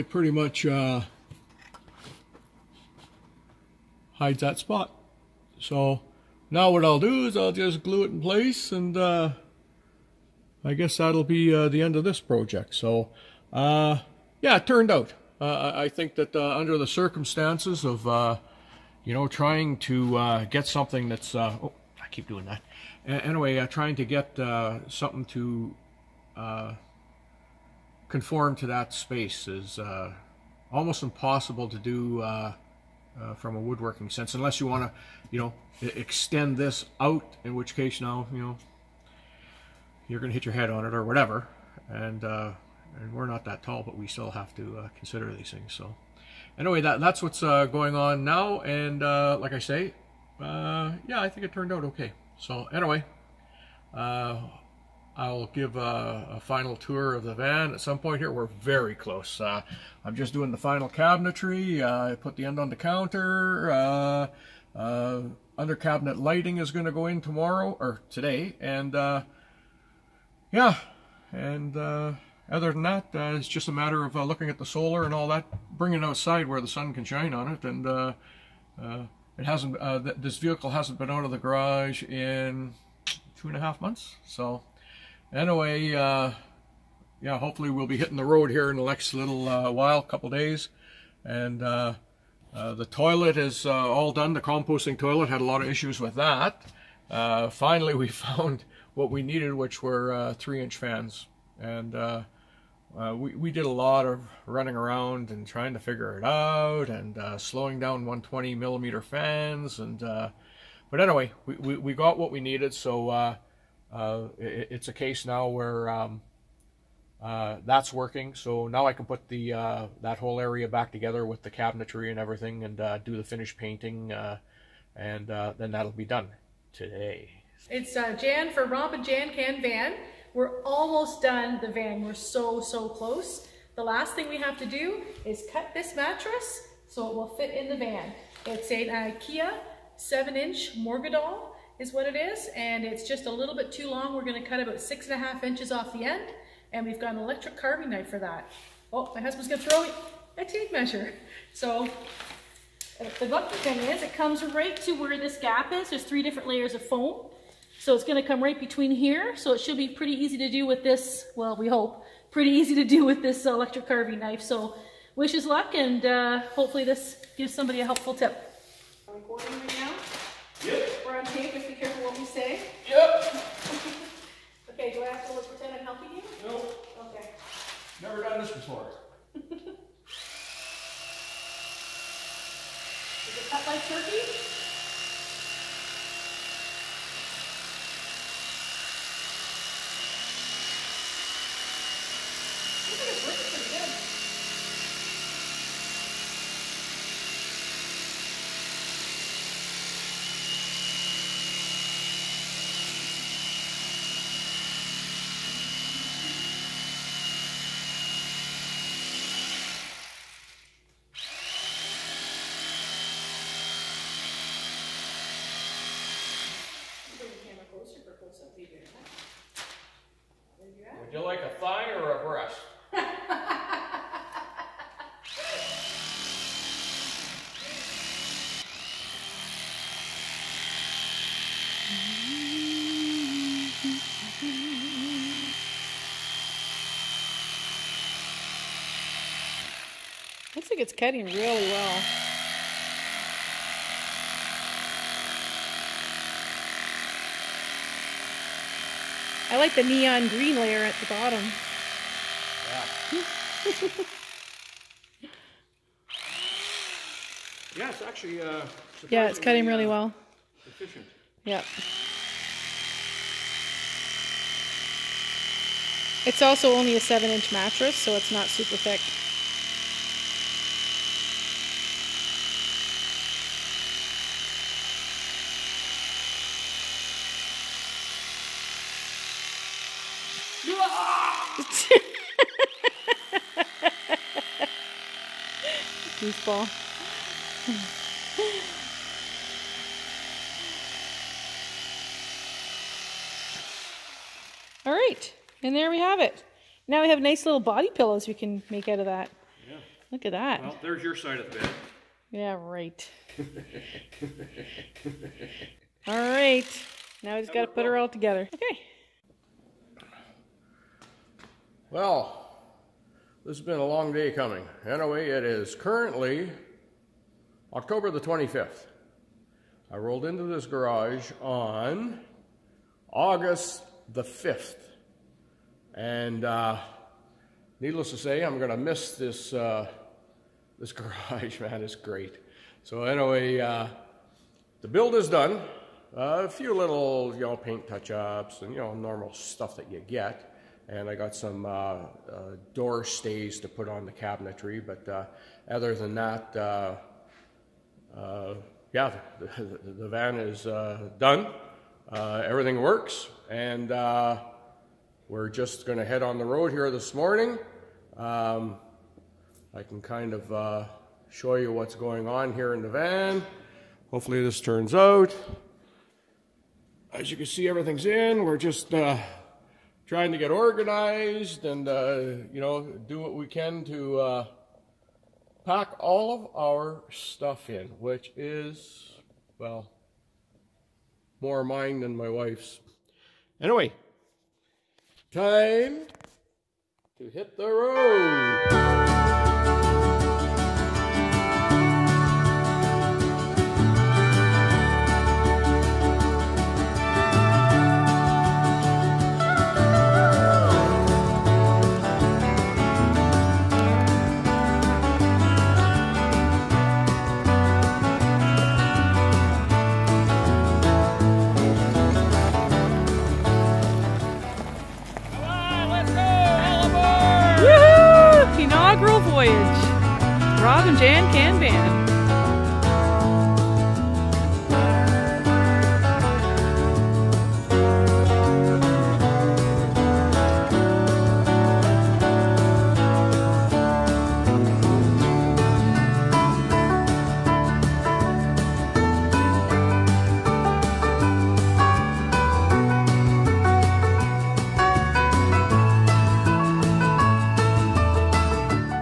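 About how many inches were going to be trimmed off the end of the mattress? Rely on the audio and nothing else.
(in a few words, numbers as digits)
6.5.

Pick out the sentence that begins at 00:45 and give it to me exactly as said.
So anyway, that, that's what's uh, going on now.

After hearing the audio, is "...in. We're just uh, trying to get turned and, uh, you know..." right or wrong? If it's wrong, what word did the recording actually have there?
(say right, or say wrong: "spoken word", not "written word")
wrong: "organized", not "turned".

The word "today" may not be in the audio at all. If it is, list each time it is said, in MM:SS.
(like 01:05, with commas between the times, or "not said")
01:08, 02:06.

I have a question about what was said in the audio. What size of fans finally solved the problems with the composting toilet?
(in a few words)
3-inch.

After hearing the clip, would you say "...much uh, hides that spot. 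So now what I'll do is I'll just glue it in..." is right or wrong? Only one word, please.
right.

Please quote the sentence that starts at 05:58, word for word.
Um, I can kind of uh, show you what's going on here in the van.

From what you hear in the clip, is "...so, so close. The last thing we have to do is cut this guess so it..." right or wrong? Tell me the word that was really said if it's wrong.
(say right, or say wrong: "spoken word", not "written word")
wrong: "mattress", not "guess".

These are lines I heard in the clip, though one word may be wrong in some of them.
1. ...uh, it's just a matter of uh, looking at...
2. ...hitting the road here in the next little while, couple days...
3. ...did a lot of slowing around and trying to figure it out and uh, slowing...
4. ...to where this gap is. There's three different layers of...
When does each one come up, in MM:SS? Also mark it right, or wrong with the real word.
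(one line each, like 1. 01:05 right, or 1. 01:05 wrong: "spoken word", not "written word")
1. 01:13 right
2. 01:27 right
3. 01:43 wrong: "running", not "slowing"
4. 02:34 right.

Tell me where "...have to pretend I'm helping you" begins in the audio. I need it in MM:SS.
02:55.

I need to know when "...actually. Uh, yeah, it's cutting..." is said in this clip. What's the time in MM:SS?
04:18.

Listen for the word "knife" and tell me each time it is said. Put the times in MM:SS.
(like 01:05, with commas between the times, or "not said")
02:27, 02:44.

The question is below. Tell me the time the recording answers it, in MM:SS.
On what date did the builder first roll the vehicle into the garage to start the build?
05:23.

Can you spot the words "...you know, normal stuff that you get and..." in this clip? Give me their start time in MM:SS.
05:38.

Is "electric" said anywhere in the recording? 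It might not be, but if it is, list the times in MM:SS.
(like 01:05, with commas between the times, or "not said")
02:27, 02:43.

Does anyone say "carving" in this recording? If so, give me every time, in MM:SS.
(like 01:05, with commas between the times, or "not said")
02:27, 02:43.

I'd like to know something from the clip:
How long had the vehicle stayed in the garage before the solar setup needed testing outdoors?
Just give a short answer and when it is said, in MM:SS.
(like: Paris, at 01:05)
two and a half months, at 01:23.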